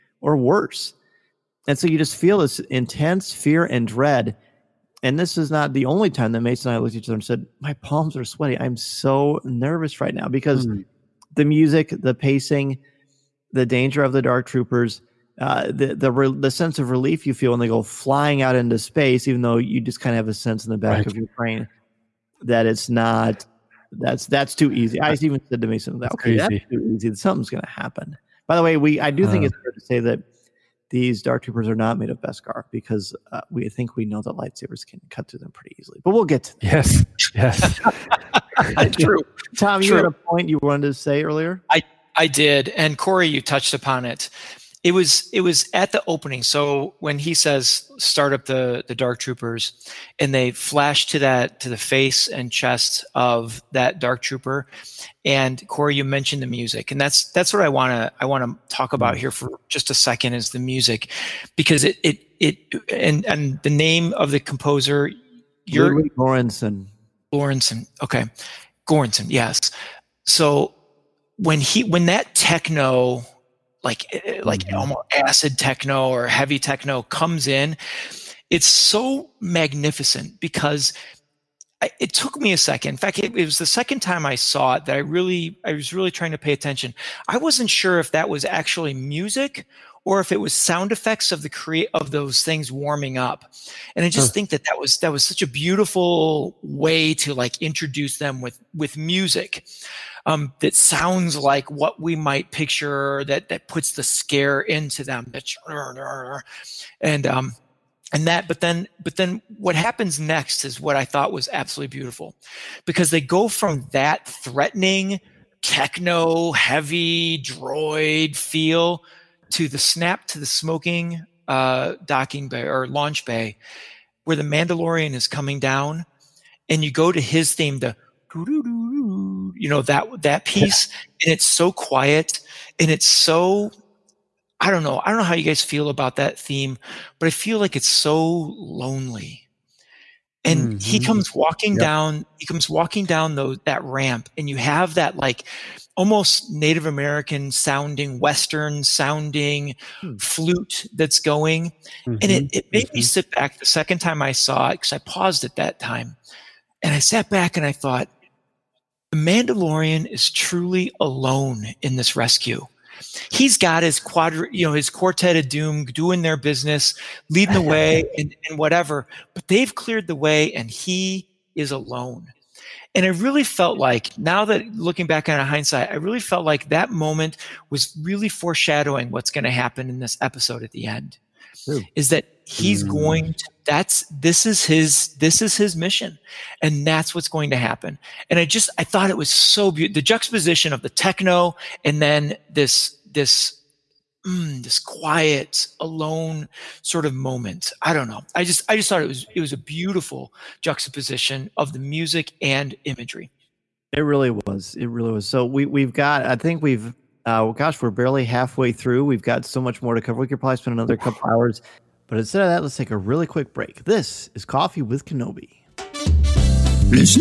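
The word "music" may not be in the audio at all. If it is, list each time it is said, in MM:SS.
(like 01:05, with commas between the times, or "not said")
00:11, 00:56, 01:00, 01:28, 01:38, 03:21.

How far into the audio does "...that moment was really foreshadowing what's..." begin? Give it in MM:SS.
02:56.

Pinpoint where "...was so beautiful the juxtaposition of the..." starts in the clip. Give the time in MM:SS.
03:09.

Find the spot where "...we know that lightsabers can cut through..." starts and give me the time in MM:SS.
00:33.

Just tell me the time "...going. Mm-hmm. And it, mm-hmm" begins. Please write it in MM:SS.
02:31.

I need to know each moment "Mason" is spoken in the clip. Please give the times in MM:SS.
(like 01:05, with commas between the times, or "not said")
00:06, 00:25.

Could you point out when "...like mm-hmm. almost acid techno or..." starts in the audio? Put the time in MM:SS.
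01:14.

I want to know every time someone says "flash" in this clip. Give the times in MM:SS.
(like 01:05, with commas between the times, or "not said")
00:50.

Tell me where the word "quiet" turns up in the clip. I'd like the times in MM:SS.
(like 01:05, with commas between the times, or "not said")
02:11, 03:14.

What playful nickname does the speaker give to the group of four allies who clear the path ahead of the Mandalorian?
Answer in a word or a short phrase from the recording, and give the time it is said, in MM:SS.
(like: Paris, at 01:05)
quartet of doom, at 02:44.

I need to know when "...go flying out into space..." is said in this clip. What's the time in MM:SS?
00:17.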